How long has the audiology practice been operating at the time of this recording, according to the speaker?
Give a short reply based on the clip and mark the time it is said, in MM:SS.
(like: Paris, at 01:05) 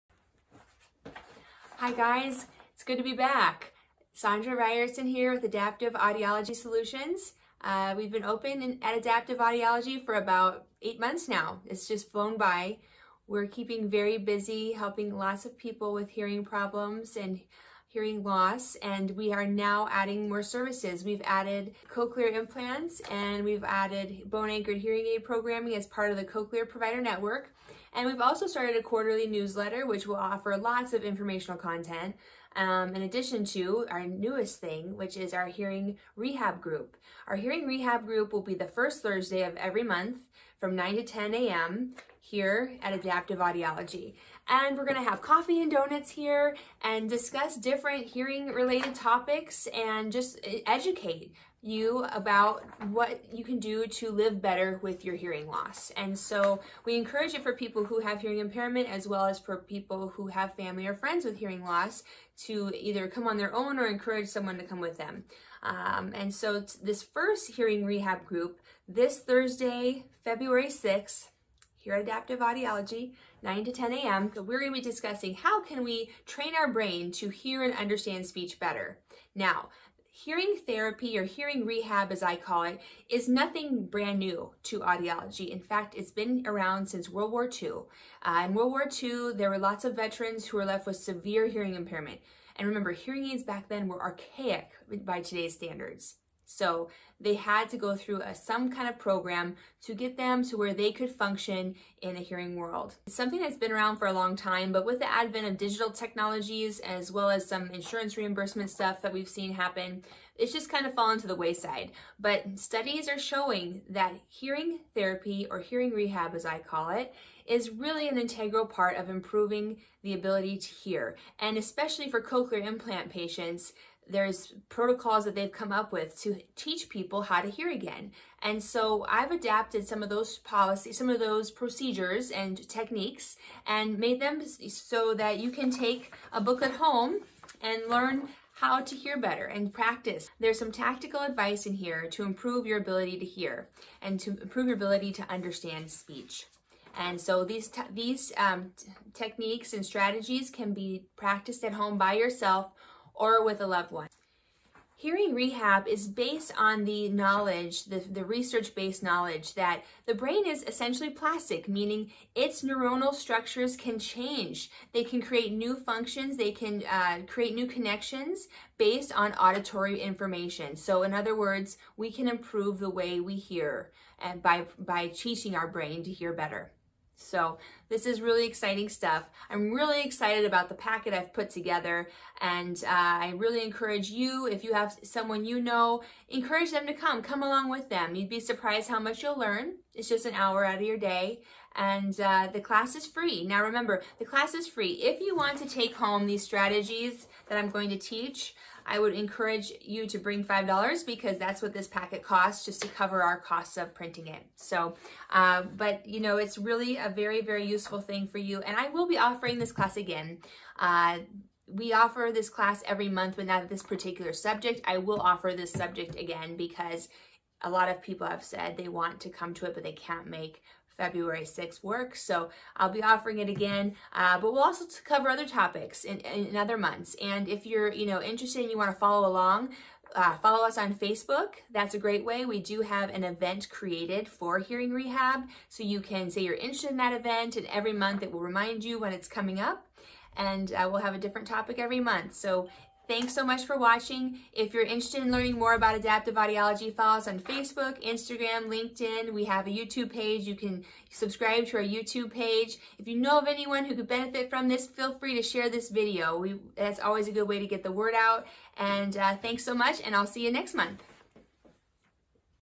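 8 months, at 00:10.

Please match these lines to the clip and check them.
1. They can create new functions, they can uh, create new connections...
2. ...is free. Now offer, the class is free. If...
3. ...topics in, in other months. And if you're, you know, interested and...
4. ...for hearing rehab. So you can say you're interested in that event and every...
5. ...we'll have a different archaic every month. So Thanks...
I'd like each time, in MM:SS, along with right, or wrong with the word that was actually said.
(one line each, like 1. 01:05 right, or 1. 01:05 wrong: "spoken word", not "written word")
1. 02:44 right
2. 03:12 wrong: "remember", not "offer"
3. 03:45 right
4. 03:54 right
5. 04:00 wrong: "topic", not "archaic".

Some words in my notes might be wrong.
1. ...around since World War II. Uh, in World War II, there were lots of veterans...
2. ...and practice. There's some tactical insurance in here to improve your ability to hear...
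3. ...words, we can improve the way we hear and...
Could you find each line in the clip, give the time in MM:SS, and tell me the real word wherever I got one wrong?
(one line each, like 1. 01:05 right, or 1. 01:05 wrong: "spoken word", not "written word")
1. 01:26 right
2. 02:19 wrong: "advice", not "insurance"
3. 02:51 right.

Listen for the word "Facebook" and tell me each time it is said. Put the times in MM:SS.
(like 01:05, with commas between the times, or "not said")
03:50, 04:07.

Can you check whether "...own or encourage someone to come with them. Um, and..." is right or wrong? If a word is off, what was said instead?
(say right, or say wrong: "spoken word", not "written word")
right.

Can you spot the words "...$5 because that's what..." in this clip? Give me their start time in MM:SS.
03:20.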